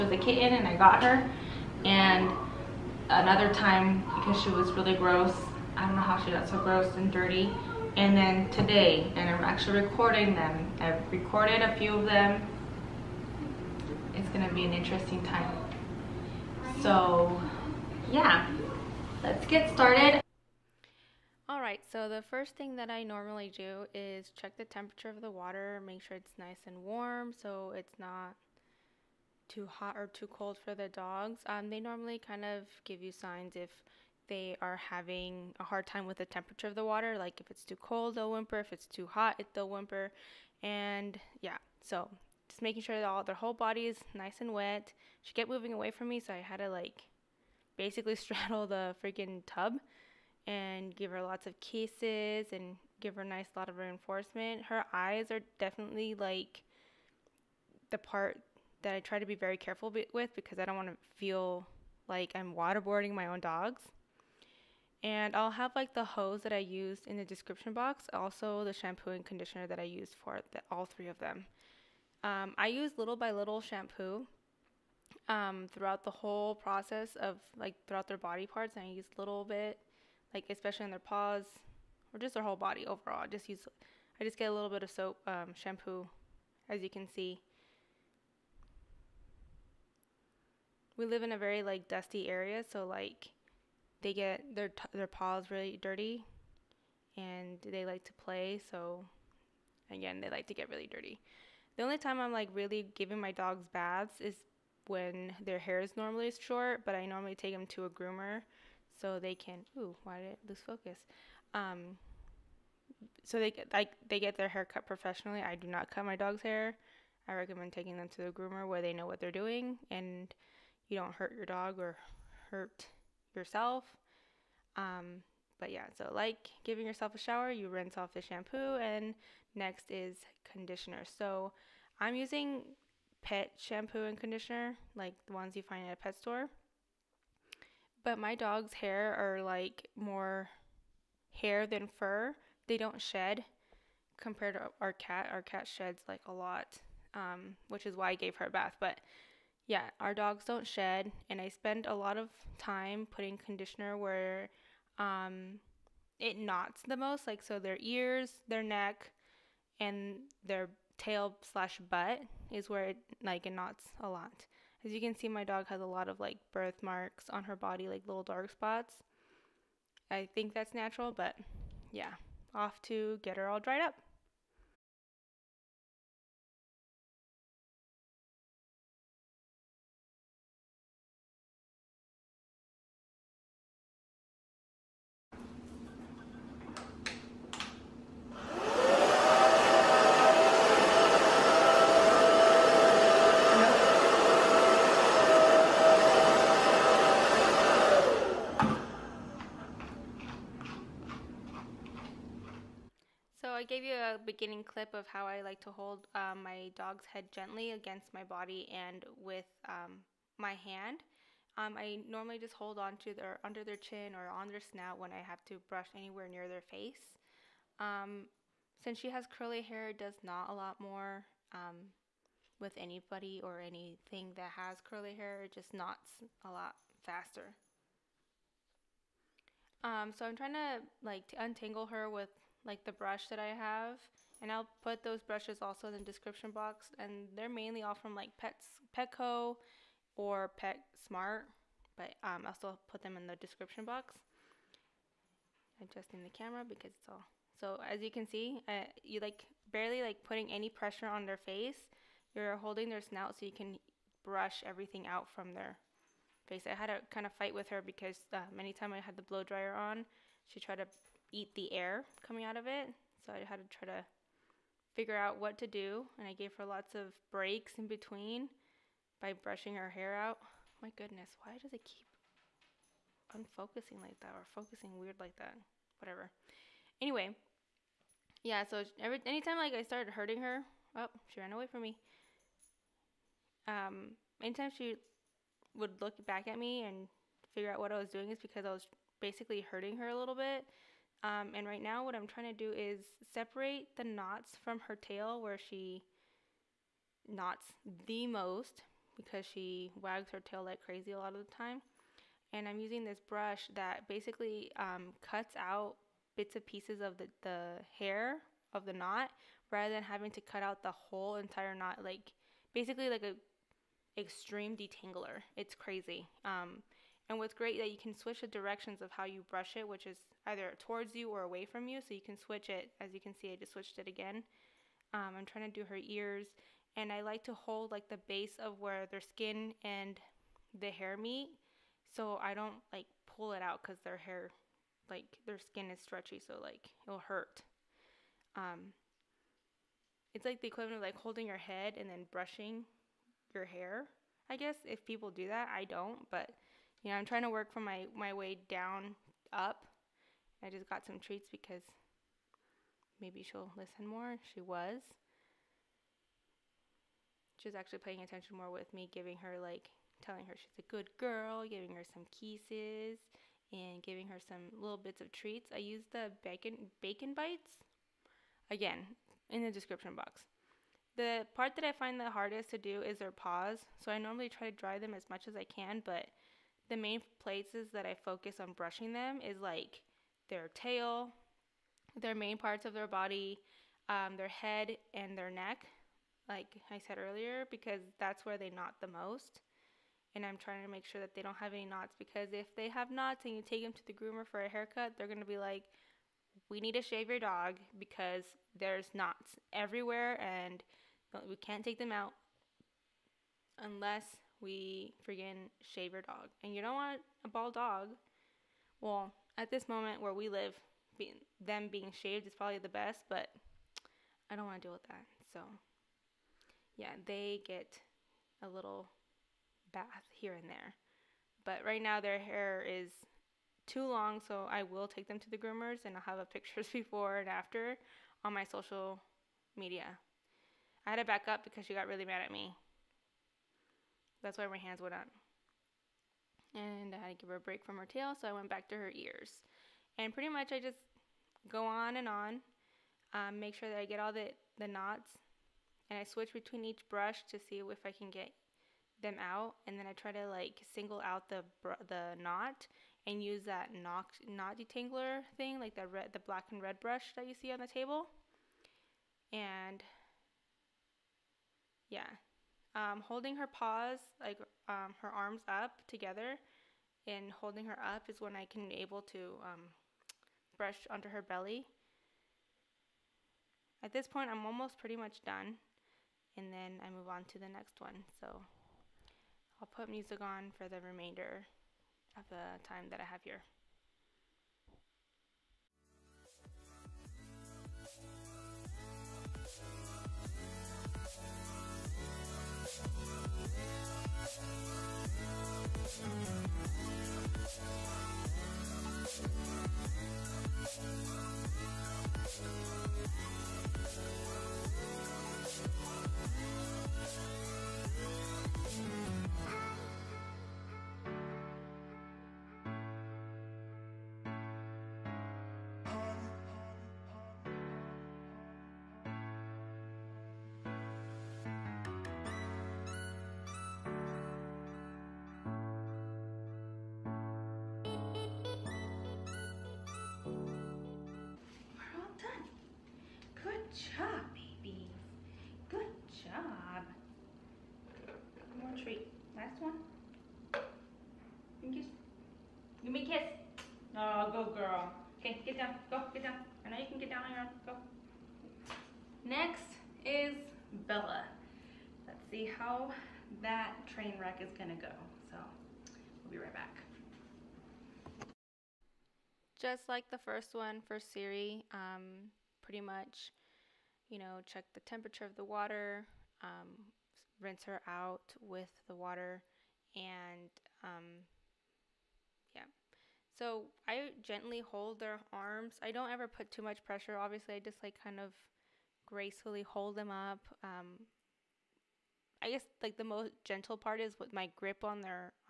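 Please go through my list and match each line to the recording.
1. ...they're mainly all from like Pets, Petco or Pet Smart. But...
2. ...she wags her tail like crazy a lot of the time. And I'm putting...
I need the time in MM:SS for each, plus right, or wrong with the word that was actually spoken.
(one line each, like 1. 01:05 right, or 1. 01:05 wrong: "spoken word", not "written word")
1. 03:57 right
2. 04:59 wrong: "using", not "putting".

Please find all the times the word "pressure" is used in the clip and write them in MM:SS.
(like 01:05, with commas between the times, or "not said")
04:10, 09:37.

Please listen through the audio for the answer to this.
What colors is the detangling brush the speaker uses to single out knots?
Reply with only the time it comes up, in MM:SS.
07:36.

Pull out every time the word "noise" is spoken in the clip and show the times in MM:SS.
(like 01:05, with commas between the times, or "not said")
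not said.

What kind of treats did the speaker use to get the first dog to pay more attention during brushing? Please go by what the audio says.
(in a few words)
Bacon bites.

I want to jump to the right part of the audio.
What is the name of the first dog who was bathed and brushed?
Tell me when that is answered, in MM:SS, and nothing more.
09:21.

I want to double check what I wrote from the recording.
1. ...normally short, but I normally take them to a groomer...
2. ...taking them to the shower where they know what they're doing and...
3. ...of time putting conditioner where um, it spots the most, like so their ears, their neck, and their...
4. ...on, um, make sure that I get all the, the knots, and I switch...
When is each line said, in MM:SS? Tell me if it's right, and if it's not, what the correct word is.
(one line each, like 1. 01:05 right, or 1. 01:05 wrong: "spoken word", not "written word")
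1. 01:45 right
2. 01:57 wrong: "groomer", not "shower"
3. 02:32 wrong: "knots", not "spots"
4. 07:22 right.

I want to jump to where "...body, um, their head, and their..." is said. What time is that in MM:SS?
06:23.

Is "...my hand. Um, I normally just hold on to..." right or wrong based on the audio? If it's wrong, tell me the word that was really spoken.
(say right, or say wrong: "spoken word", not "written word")
right.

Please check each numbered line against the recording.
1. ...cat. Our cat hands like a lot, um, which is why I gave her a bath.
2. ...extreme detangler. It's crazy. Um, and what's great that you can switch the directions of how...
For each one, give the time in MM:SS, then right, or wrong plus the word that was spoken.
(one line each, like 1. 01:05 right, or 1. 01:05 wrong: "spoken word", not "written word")
1. 02:24 wrong: "sheds", not "hands"
2. 05:14 right.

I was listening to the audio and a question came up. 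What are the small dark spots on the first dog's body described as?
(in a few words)
Birthmarks.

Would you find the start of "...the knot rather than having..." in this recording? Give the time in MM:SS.
05:08.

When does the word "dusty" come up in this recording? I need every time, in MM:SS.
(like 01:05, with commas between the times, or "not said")
01:31.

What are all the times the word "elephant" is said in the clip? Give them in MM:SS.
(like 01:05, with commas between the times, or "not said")
not said.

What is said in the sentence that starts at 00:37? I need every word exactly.
Like if it's too cold, they'll whimper.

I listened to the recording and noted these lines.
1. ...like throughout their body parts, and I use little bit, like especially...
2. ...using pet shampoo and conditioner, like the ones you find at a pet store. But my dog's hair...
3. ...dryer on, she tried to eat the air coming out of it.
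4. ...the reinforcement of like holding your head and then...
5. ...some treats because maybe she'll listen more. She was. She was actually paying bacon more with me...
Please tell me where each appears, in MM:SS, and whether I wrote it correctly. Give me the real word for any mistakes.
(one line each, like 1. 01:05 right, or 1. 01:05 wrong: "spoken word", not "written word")
1. 01:17 right
2. 02:12 right
3. 04:19 right
4. 05:40 wrong: "equivalent", not "reinforcement"
5. 05:51 wrong: "attention", not "bacon".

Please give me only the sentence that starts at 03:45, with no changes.
It just knots a lot faster.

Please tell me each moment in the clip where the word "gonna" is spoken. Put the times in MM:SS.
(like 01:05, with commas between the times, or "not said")
00:14, 09:14.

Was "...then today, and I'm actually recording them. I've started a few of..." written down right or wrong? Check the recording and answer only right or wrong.
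wrong.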